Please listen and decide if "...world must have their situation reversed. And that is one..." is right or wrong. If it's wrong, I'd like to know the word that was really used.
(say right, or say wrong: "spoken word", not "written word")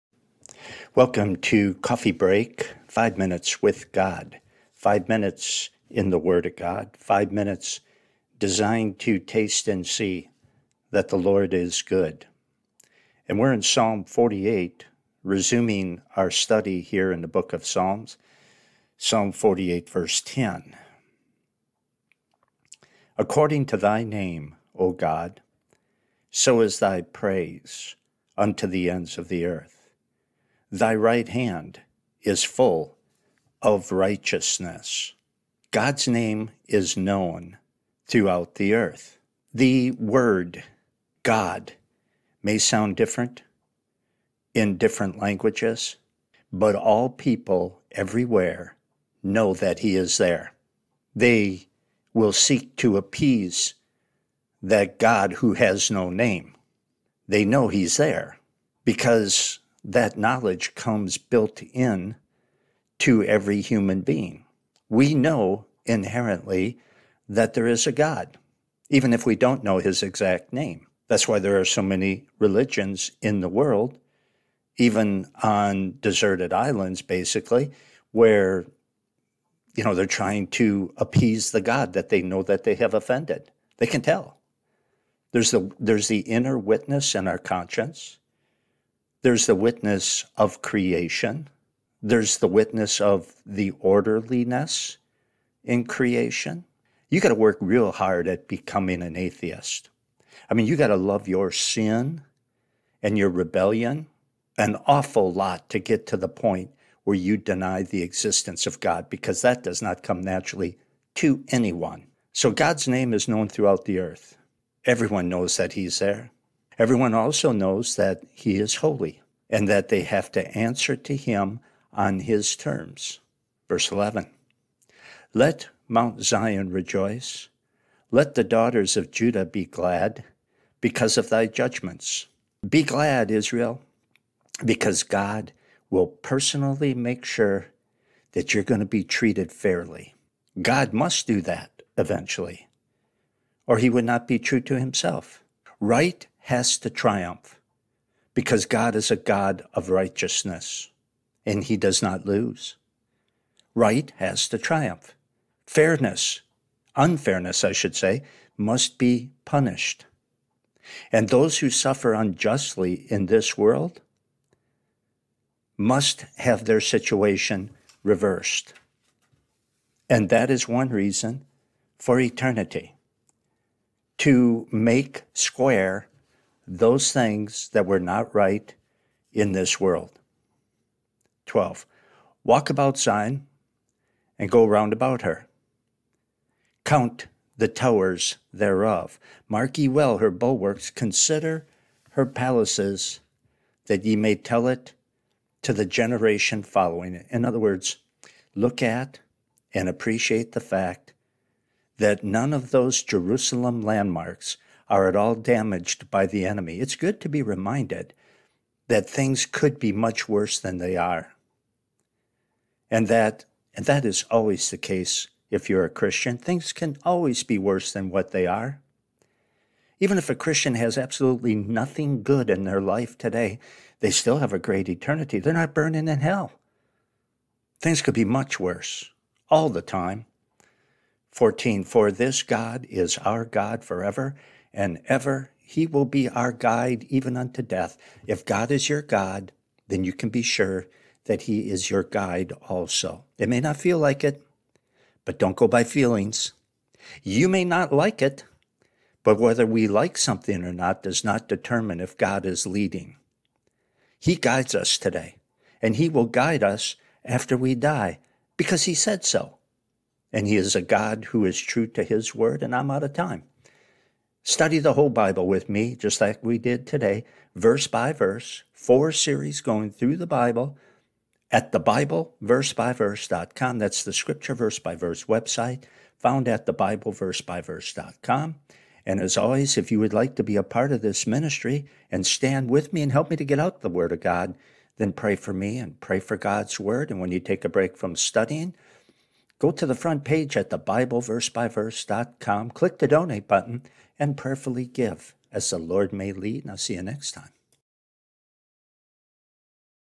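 right.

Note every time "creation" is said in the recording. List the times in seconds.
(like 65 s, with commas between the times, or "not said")
90 s, 95 s.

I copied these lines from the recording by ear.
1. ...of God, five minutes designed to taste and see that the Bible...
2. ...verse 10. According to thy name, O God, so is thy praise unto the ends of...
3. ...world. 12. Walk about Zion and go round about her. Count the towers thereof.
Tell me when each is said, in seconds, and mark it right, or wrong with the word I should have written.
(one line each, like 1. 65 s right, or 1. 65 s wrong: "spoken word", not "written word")
1. 6 s wrong: "Lord", not "Bible"
2. 19 s right
3. 179 s right.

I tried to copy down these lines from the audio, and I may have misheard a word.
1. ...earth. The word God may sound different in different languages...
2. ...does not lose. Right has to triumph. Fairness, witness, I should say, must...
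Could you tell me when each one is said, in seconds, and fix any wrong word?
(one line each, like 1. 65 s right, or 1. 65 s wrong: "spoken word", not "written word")
1. 38 s right
2. 151 s wrong: "unfairness", not "witness".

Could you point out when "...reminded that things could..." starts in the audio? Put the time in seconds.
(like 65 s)
207 s.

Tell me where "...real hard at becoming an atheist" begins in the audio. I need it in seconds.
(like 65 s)
97 s.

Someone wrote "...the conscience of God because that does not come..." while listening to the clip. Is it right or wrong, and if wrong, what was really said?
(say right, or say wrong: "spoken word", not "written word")
wrong: "existence", not "conscience".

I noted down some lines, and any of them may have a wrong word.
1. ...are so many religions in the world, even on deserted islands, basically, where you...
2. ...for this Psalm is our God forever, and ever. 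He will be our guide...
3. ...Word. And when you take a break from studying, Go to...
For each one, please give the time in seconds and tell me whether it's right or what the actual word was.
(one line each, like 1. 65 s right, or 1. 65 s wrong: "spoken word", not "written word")
1. 71 s right
2. 231 s wrong: "God", not "Psalm"
3. 286 s right.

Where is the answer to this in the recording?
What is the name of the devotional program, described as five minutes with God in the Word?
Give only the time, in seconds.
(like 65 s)
1 s.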